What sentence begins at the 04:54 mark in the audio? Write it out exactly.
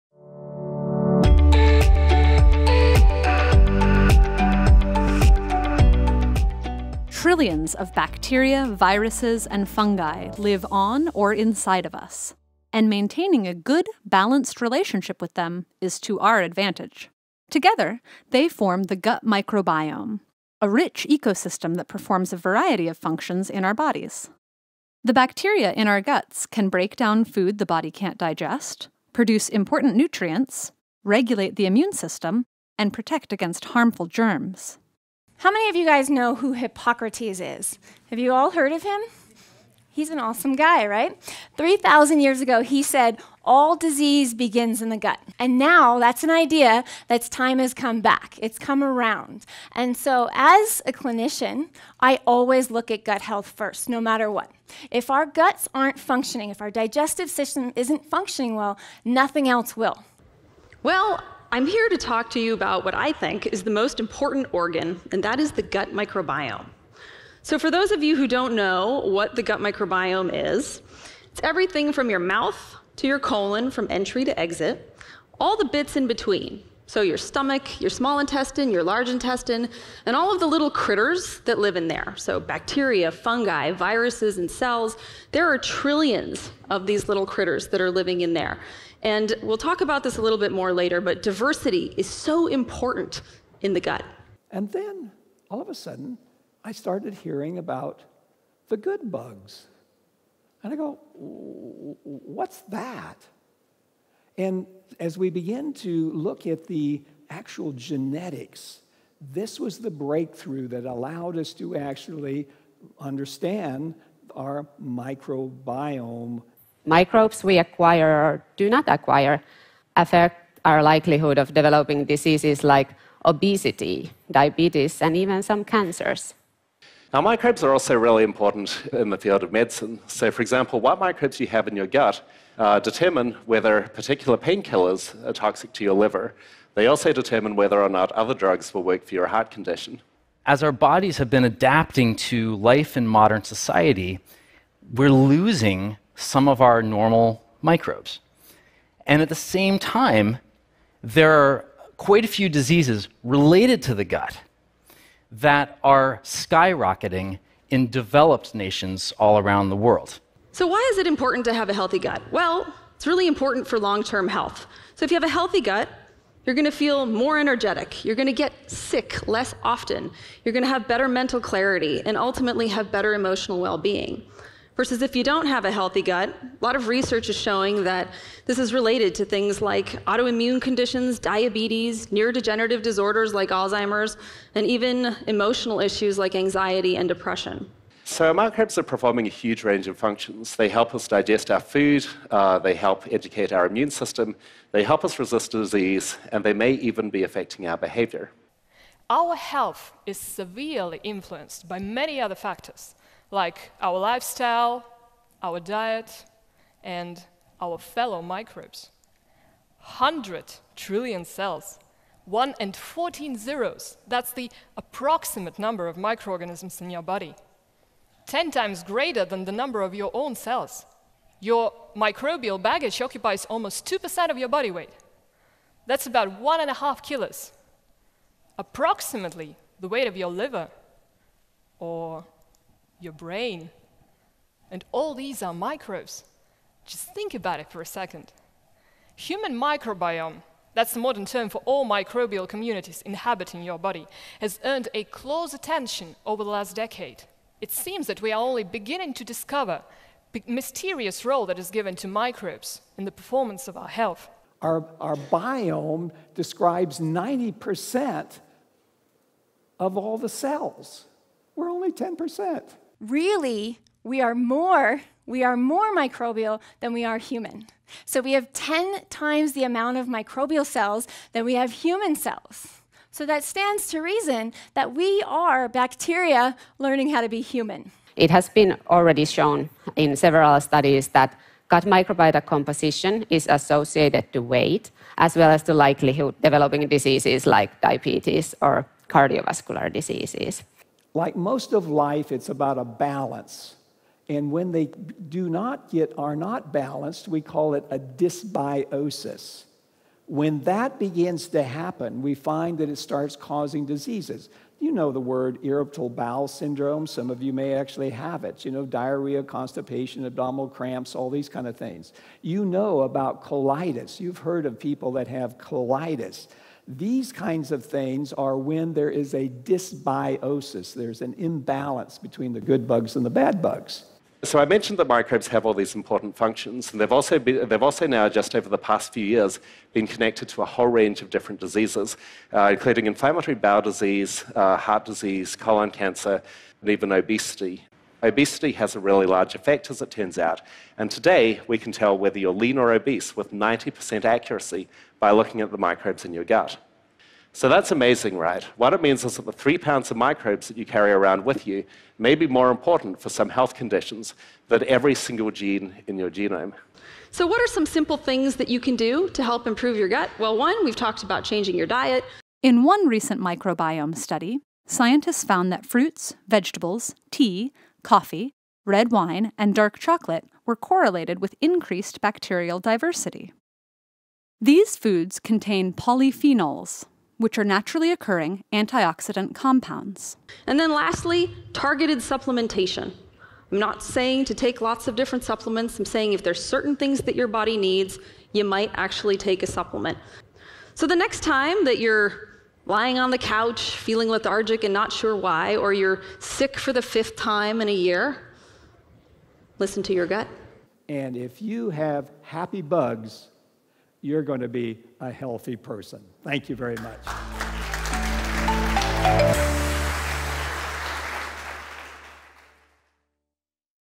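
And when they do not get, are not balanced, we call it a dysbiosis.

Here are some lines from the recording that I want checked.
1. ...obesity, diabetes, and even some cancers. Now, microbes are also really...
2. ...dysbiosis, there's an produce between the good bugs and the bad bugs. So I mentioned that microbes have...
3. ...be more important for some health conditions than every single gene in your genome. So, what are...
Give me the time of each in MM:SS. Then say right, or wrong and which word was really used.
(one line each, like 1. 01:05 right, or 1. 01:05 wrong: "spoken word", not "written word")
1. 02:03 right
2. 05:19 wrong: "imbalance", not "produce"
3. 05:52 right.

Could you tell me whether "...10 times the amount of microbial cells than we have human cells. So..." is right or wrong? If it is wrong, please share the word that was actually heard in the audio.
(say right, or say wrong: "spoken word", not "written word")
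right.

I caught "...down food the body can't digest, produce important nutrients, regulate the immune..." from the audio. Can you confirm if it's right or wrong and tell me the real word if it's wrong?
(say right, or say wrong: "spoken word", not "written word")
right.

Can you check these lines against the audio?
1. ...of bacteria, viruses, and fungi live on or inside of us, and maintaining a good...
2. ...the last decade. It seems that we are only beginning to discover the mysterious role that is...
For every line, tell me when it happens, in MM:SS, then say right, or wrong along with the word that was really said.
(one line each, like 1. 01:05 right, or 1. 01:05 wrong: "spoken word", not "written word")
1. 00:07 right
2. 04:06 right.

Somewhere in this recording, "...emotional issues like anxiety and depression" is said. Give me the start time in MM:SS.
03:05.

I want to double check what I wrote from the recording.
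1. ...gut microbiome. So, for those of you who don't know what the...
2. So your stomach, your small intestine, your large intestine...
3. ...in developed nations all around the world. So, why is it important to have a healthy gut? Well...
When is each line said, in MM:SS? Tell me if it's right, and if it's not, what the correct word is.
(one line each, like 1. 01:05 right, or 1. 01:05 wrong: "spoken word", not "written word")
1. 01:05 right
2. 01:16 right
3. 02:37 right.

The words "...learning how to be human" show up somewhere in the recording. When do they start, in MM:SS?
04:36.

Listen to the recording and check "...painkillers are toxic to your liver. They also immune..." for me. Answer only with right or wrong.
wrong.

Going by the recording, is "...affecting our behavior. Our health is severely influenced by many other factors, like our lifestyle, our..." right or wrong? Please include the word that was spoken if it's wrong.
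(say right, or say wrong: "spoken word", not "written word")
right.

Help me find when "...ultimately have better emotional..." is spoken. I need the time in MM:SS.
02:52.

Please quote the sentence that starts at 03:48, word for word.
Approximately the weight of your liver or your brain.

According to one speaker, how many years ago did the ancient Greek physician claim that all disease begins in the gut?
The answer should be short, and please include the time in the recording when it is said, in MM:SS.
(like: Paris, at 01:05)
3,000, at 00:41.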